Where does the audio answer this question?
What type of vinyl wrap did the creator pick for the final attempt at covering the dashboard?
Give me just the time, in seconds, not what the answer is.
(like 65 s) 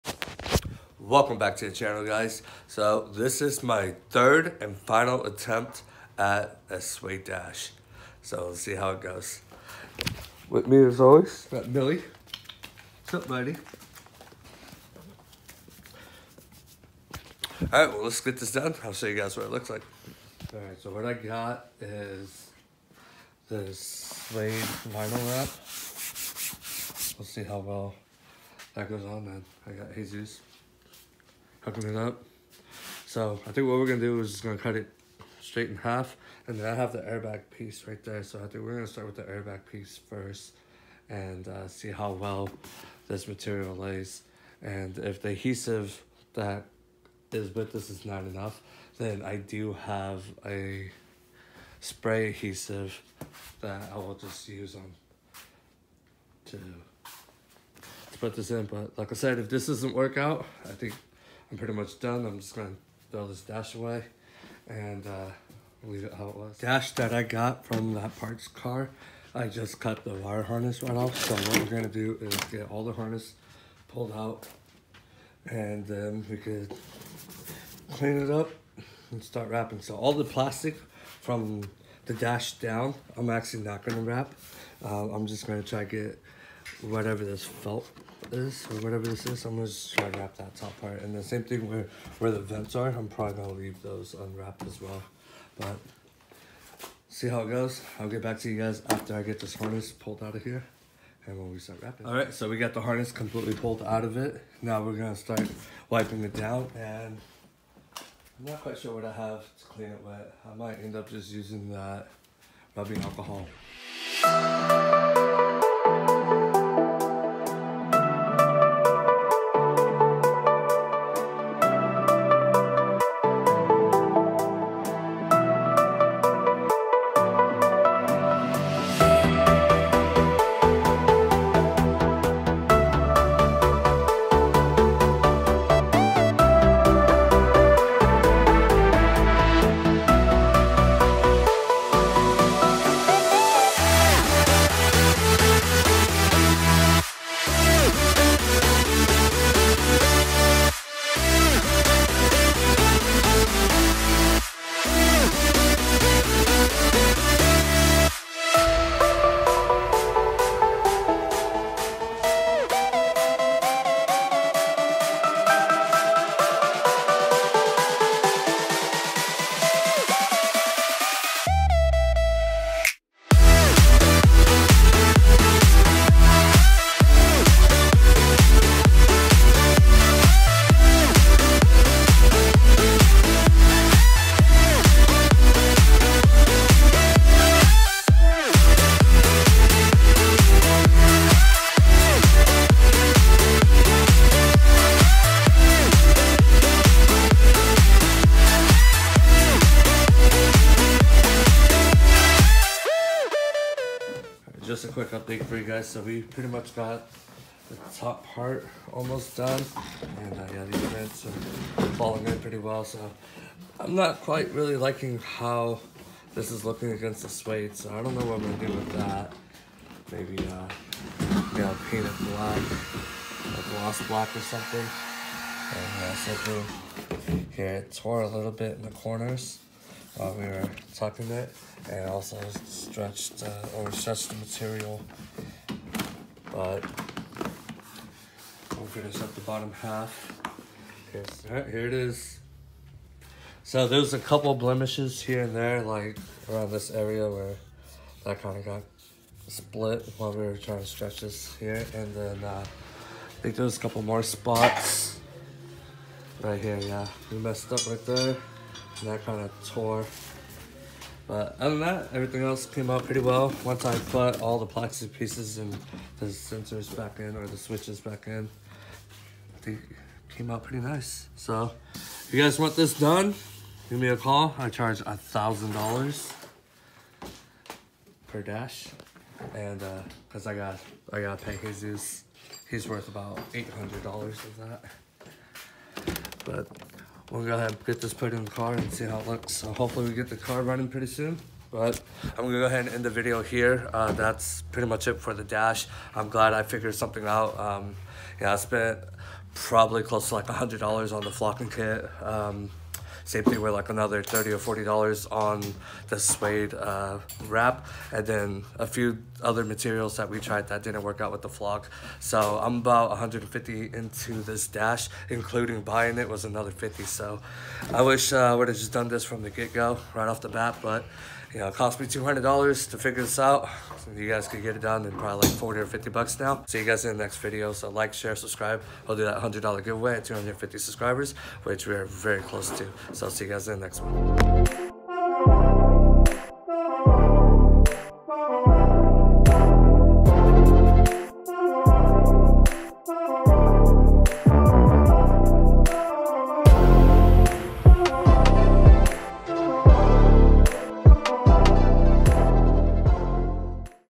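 24 s.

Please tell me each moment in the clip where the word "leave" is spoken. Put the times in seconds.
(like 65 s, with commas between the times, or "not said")
65 s, 93 s.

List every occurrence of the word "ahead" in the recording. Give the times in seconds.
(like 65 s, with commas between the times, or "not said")
287 s, 292 s.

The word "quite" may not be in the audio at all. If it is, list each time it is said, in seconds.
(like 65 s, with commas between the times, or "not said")
108 s, 214 s.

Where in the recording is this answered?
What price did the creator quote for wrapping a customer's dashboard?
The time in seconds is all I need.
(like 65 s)
275 s.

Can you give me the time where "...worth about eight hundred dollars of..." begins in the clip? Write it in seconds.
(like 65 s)
282 s.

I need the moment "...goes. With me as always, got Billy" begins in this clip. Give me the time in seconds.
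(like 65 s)
9 s.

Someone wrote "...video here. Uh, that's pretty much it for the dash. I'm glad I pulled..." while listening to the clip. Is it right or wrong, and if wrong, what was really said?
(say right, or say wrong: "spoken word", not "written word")
wrong: "figured", not "pulled".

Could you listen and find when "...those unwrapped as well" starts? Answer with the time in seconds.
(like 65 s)
93 s.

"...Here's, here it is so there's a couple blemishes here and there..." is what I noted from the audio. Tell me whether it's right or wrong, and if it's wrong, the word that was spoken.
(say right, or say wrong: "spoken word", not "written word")
right.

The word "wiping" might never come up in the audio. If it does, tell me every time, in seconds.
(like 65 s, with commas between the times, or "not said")
105 s.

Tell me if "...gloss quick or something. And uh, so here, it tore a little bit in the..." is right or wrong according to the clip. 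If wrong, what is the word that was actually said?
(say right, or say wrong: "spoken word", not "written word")
wrong: "black", not "quick".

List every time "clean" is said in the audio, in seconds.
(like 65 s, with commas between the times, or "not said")
77 s, 109 s.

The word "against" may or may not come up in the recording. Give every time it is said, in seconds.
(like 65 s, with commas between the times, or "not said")
216 s.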